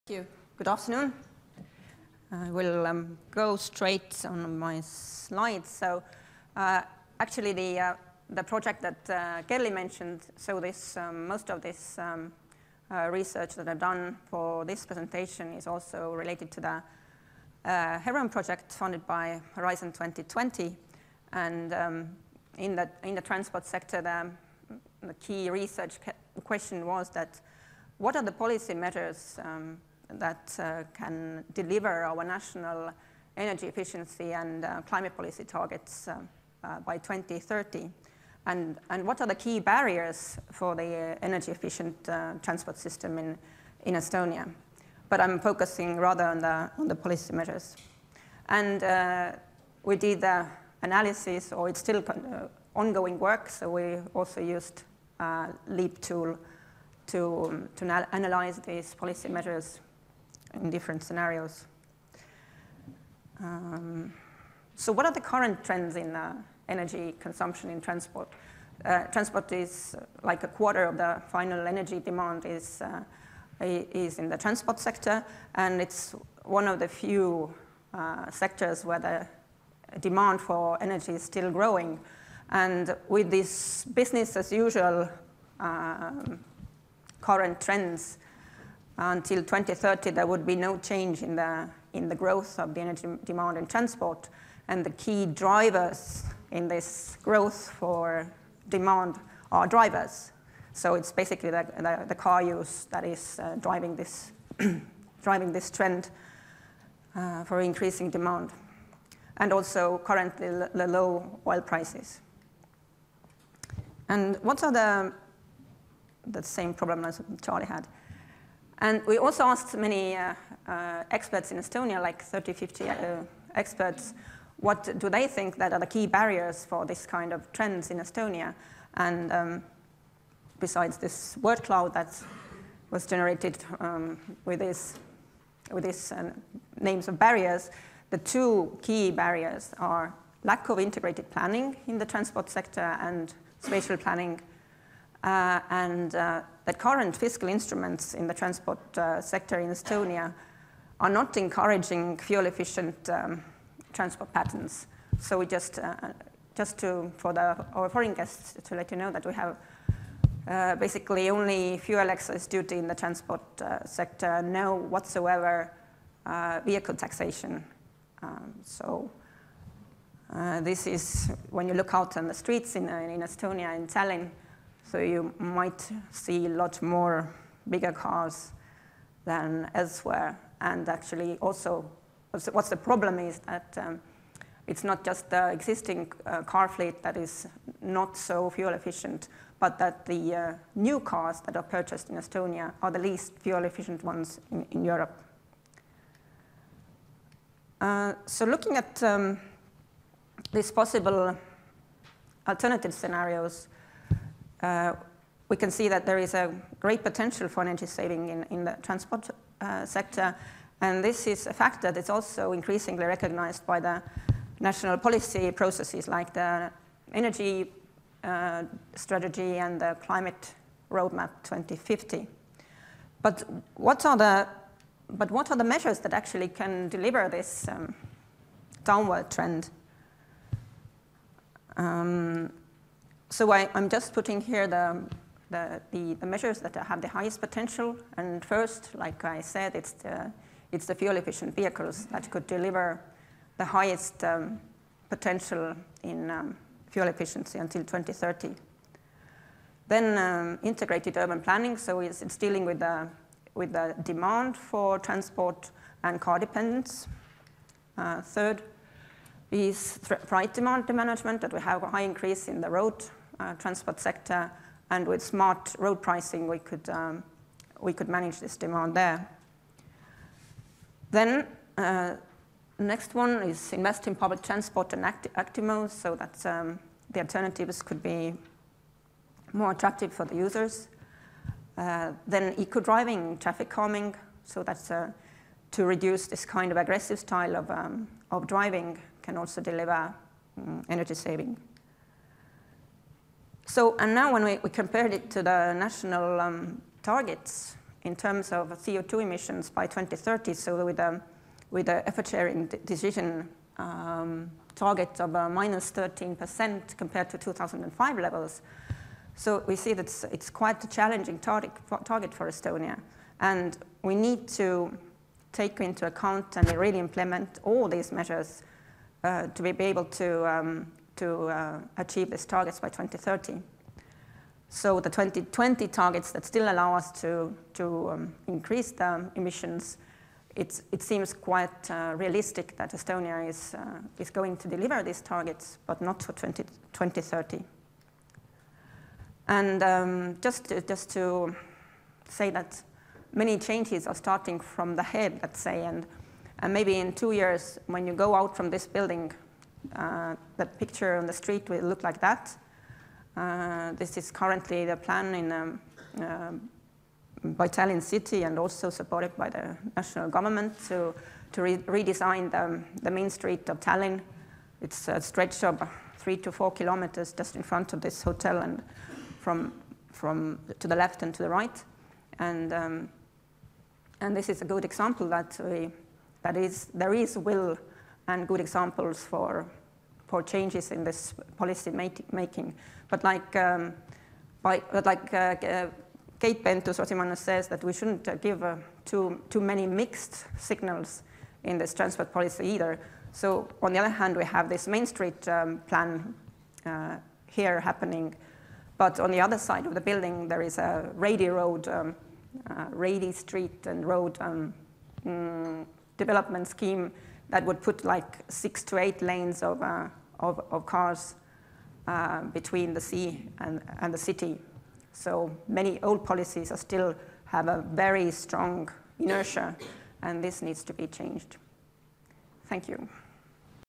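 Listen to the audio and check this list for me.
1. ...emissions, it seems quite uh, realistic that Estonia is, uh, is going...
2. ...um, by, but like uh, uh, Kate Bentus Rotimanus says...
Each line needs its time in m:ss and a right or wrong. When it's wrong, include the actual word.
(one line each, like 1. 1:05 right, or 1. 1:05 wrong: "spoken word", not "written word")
1. 5:29 right
2. 6:23 right.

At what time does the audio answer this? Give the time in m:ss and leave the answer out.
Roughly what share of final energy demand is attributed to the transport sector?
1:10.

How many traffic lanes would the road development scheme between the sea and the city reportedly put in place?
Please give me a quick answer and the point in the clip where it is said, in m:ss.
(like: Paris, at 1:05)
6 to 8, at 6:48.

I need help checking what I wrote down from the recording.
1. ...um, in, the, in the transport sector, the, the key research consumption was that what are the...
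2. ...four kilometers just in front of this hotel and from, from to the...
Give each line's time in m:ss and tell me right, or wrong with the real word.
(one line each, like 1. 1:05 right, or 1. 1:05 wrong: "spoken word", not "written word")
1. 0:21 wrong: "question", not "consumption"
2. 6:06 right.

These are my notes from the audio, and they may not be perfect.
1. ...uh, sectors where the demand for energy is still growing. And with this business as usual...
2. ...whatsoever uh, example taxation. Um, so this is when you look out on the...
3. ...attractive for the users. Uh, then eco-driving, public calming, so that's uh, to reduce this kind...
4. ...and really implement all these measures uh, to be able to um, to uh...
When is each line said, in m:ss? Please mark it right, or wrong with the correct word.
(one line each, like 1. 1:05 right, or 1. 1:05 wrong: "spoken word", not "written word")
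1. 1:17 right
2. 2:44 wrong: "vehicle", not "example"
3. 4:39 wrong: "traffic", not "public"
4. 5:16 right.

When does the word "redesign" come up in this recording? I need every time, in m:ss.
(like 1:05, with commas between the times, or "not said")
6:01.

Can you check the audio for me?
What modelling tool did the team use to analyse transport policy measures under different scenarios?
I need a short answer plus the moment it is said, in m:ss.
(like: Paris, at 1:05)
LEAP, at 0:55.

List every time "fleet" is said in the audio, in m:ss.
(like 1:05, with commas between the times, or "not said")
3:06.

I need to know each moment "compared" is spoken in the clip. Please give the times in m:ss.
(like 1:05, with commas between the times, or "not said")
4:54, 5:06.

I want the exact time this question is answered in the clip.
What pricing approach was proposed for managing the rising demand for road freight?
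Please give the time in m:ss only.
4:25.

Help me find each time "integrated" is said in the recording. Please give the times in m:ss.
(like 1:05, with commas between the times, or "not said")
2:20, 4:10.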